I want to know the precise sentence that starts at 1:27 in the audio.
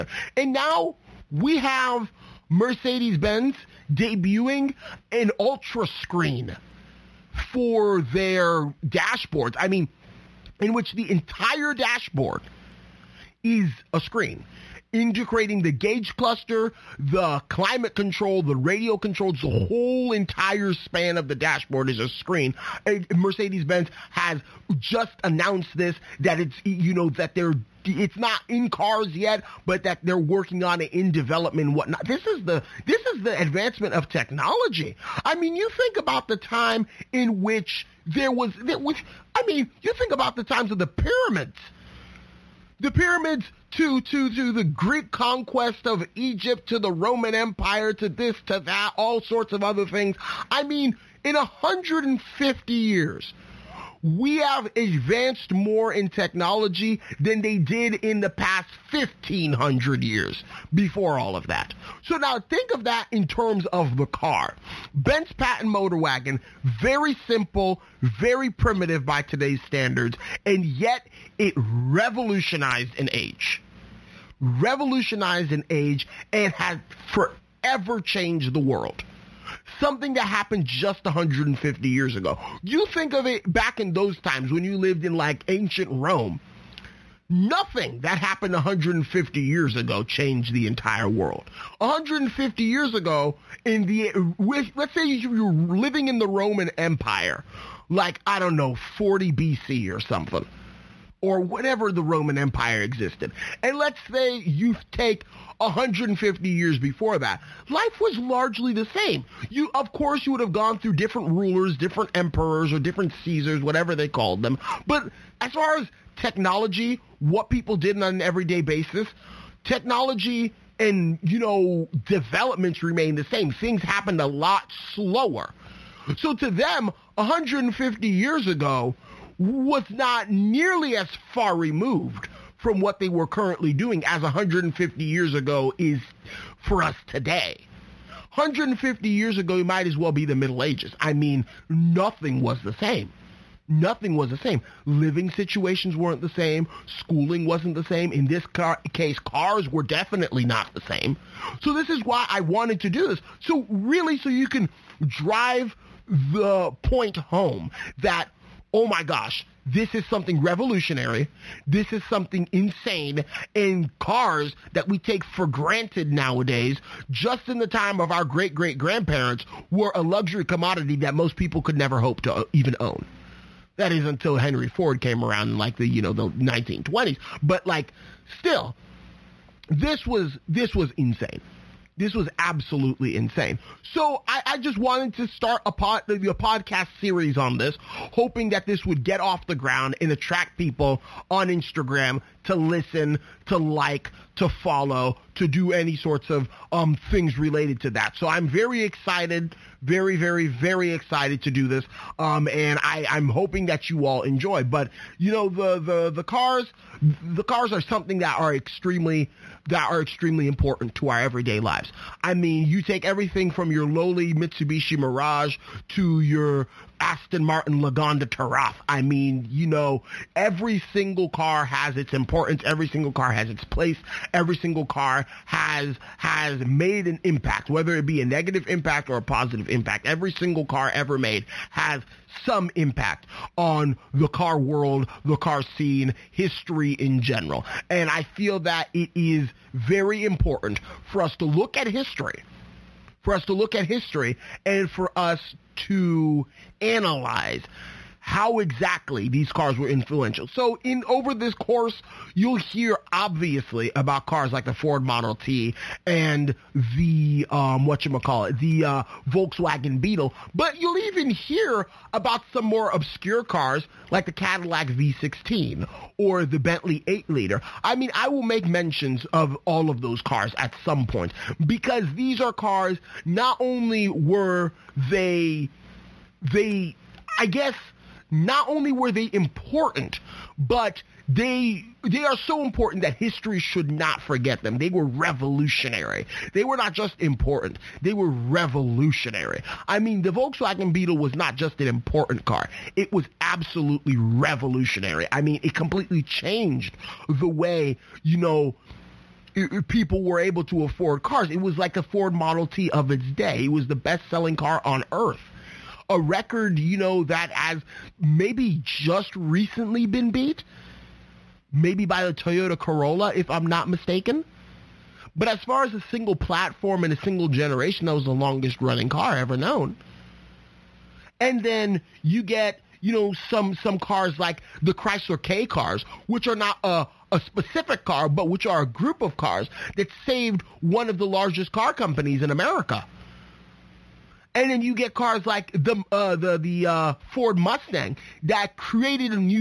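Nothing that happened 150 years ago changed the entire world.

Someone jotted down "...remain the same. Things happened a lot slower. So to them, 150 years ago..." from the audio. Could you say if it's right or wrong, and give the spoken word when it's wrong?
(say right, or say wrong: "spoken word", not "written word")
right.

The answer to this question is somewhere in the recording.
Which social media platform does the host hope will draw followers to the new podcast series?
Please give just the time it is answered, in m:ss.
3:11.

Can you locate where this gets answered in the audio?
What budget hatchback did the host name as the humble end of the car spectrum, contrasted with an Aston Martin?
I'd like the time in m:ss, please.
3:34.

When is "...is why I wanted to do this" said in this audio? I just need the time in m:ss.
2:31.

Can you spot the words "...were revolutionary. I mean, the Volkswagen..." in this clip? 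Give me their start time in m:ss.
4:48.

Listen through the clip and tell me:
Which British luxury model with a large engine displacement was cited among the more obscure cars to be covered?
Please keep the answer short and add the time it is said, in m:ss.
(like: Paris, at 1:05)
Bentley 8 liter, at 4:26.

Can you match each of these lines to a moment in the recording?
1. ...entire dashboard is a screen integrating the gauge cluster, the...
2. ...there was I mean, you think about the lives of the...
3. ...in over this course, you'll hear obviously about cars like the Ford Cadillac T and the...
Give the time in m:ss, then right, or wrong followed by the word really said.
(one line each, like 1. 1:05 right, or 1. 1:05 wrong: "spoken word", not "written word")
1. 0:11 right
2. 0:38 wrong: "times", not "lives"
3. 4:10 wrong: "Model", not "Cadillac".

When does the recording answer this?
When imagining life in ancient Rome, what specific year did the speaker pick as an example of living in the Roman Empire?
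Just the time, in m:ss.
1:38.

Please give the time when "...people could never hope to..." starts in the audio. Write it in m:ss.
2:51.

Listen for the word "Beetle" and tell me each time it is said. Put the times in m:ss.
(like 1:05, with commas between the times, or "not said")
4:19, 4:50.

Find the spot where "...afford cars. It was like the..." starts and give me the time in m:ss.
5:00.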